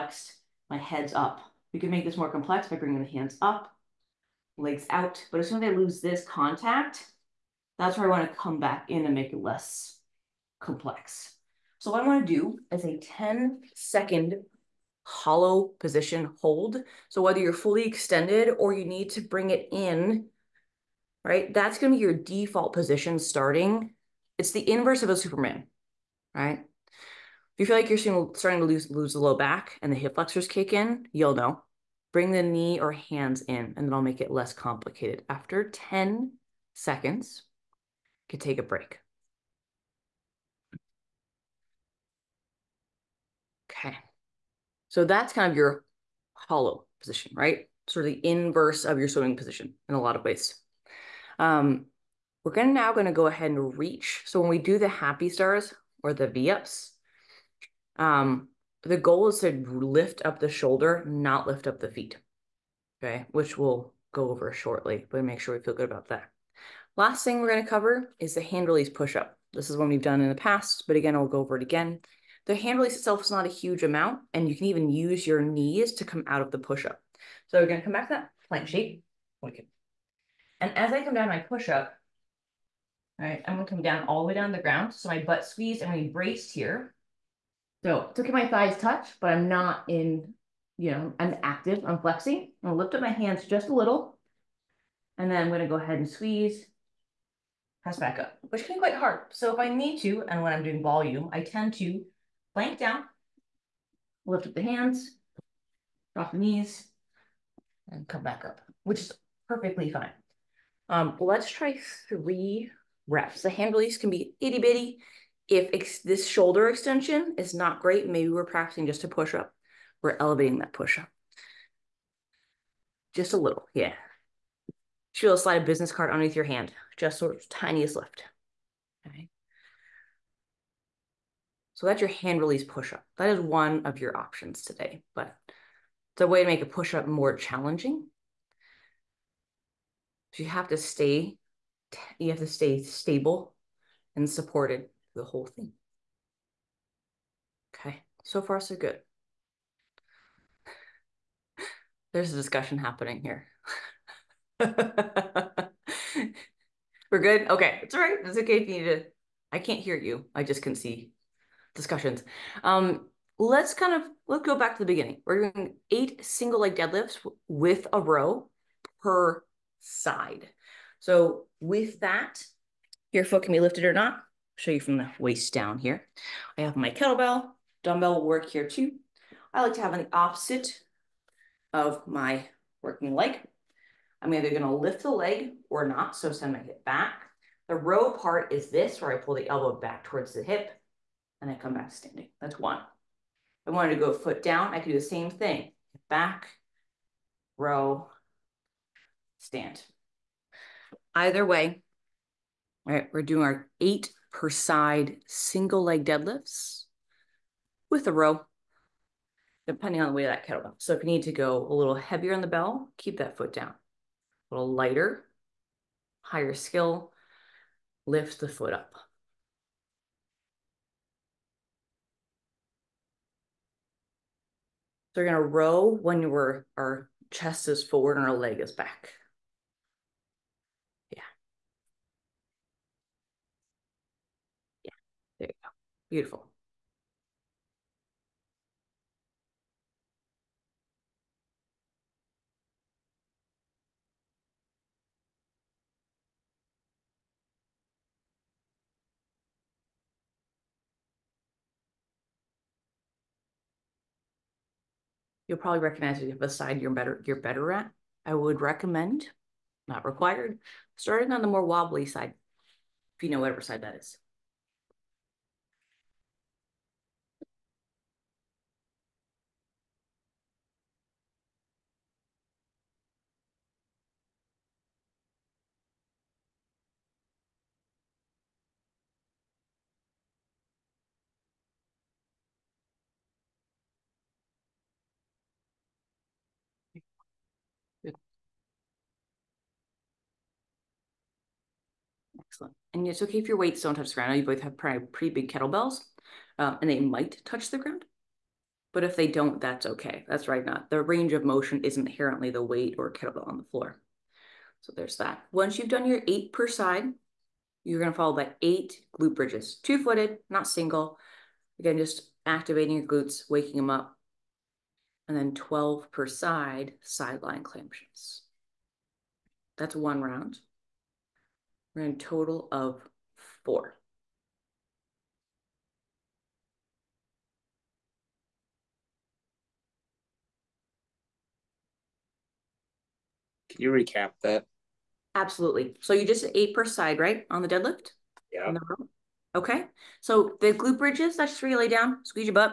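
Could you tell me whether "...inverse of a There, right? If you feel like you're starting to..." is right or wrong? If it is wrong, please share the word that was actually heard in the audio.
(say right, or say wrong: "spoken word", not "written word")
wrong: "Superman", not "There".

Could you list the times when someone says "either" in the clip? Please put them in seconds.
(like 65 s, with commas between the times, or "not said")
184 s, 201 s.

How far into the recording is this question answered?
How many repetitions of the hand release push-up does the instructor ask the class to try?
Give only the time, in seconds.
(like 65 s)
112 s.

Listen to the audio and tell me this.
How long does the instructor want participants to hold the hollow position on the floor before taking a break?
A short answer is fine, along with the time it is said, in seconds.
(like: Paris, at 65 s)
10 seconds, at 12 s.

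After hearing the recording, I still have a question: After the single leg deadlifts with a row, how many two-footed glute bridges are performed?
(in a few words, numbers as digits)
8.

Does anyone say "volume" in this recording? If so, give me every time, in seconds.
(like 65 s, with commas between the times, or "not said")
100 s.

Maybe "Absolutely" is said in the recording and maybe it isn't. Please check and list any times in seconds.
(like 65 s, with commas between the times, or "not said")
335 s.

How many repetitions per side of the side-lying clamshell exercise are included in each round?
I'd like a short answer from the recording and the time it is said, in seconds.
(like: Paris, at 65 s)
12, at 315 s.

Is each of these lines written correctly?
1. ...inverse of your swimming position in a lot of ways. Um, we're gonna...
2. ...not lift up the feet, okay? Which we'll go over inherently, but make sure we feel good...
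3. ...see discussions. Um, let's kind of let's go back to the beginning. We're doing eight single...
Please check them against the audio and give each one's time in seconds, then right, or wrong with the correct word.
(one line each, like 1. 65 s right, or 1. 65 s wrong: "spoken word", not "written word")
1. 48 s right
2. 61 s wrong: "shortly", not "inherently"
3. 160 s right.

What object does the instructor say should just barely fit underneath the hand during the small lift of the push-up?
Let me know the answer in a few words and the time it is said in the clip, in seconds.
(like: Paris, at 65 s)
business card, at 125 s.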